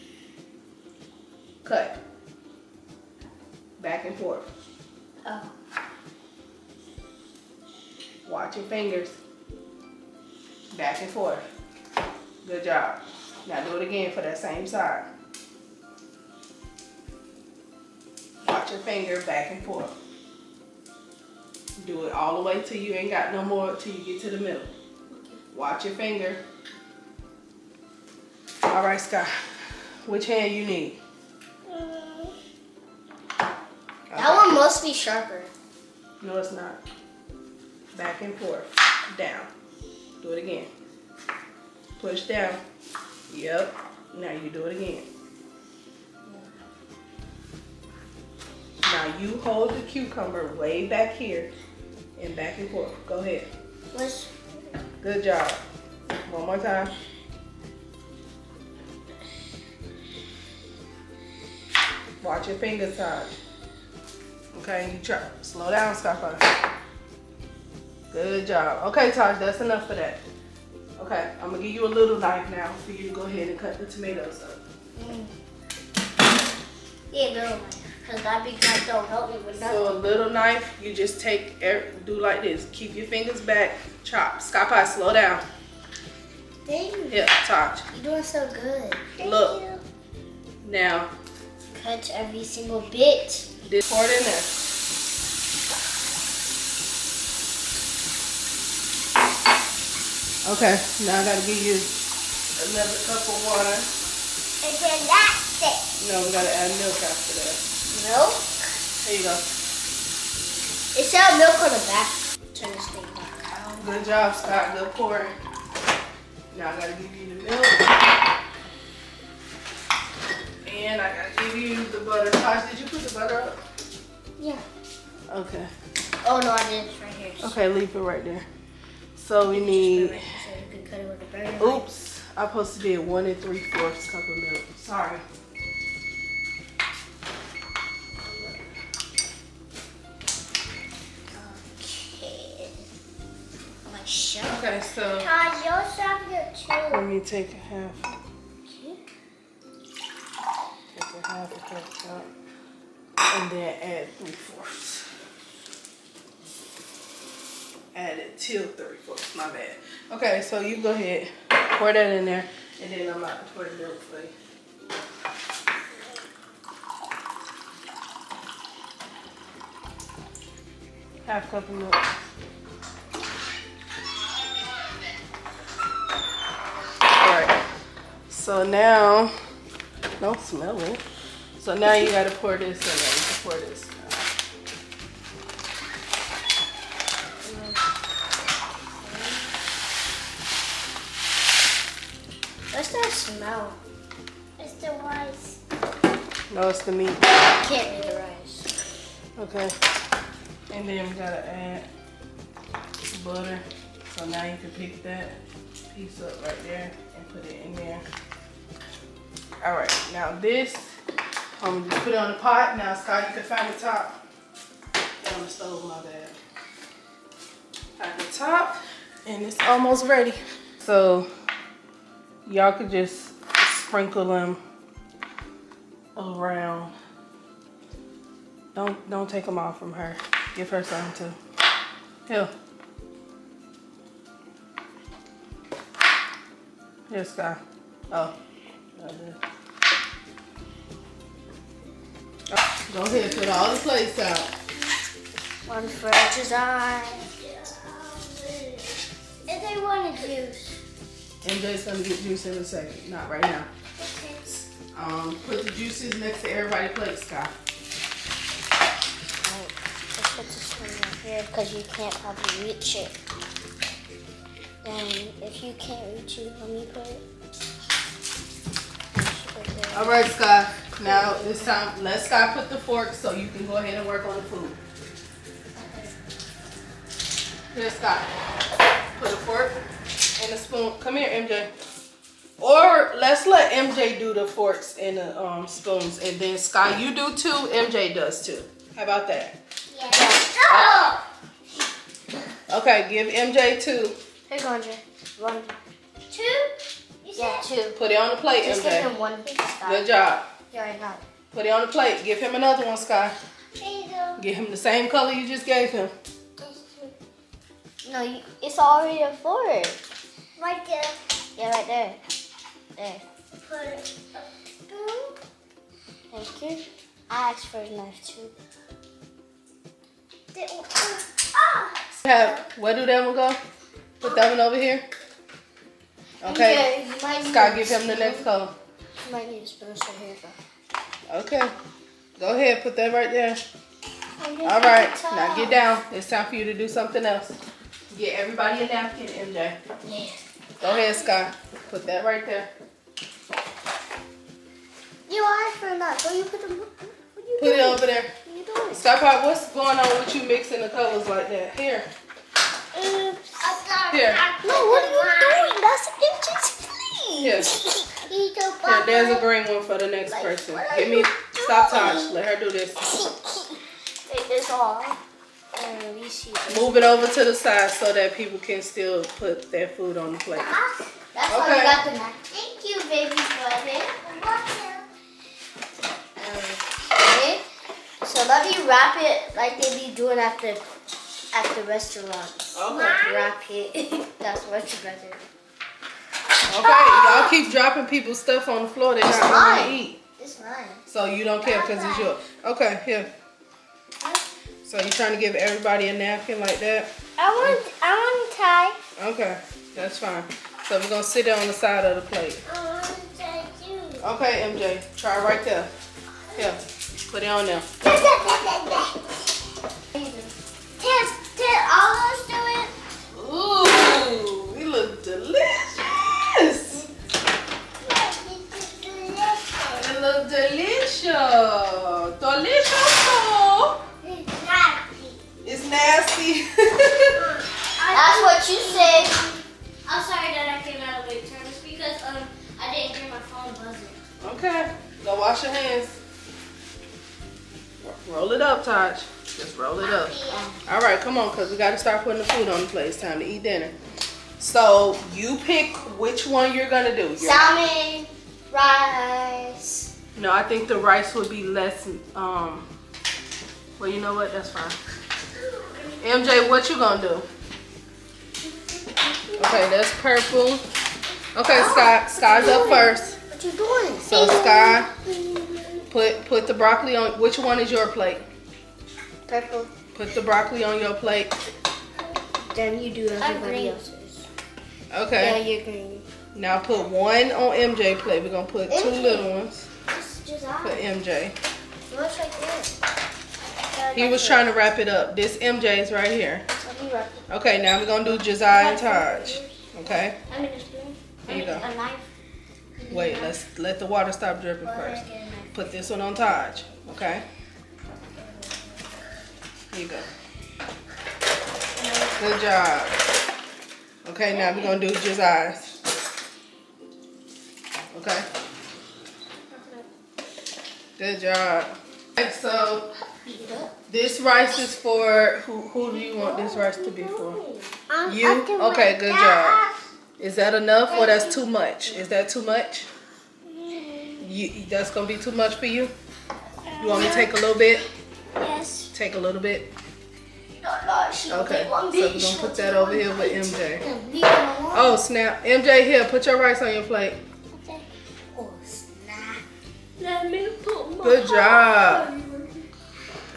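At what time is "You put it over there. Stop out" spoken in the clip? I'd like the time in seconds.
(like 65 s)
347 s.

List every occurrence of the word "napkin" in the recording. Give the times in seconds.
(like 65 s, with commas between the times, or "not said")
338 s, 396 s.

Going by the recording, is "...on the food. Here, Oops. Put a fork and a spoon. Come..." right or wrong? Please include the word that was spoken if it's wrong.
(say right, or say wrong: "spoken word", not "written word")
wrong: "Scott", not "Oops".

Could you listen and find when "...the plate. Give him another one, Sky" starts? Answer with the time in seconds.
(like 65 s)
301 s.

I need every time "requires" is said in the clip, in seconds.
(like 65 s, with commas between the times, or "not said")
not said.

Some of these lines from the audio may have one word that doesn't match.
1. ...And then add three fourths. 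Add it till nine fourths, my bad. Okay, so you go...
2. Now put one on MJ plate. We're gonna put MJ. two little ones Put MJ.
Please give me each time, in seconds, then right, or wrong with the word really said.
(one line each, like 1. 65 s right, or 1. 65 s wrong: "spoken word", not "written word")
1. 153 s wrong: "three", not "nine"
2. 476 s right.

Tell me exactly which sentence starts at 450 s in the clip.
No, I think the rice would be less.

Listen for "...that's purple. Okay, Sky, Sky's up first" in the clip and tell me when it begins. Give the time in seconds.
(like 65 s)
459 s.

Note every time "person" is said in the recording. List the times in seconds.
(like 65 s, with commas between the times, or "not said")
360 s.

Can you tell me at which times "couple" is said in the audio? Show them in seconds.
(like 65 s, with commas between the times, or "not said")
not said.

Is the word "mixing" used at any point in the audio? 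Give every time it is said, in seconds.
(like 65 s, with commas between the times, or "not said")
350 s.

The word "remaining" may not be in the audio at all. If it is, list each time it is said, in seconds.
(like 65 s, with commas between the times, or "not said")
not said.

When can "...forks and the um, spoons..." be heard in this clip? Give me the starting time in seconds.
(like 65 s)
284 s.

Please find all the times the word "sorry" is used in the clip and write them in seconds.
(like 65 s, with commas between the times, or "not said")
134 s, 430 s.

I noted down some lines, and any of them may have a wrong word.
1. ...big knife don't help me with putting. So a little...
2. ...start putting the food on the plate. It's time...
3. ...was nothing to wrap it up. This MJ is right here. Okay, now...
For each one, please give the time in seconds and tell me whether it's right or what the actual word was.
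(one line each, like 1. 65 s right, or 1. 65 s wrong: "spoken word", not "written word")
1. 78 s wrong: "nothing", not "putting"
2. 441 s right
3. 484 s wrong: "trying", not "nothing".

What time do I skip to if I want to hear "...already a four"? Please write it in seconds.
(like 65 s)
308 s.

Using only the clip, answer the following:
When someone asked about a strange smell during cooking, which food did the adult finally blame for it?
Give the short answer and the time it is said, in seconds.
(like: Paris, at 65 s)
The meat, at 196 s.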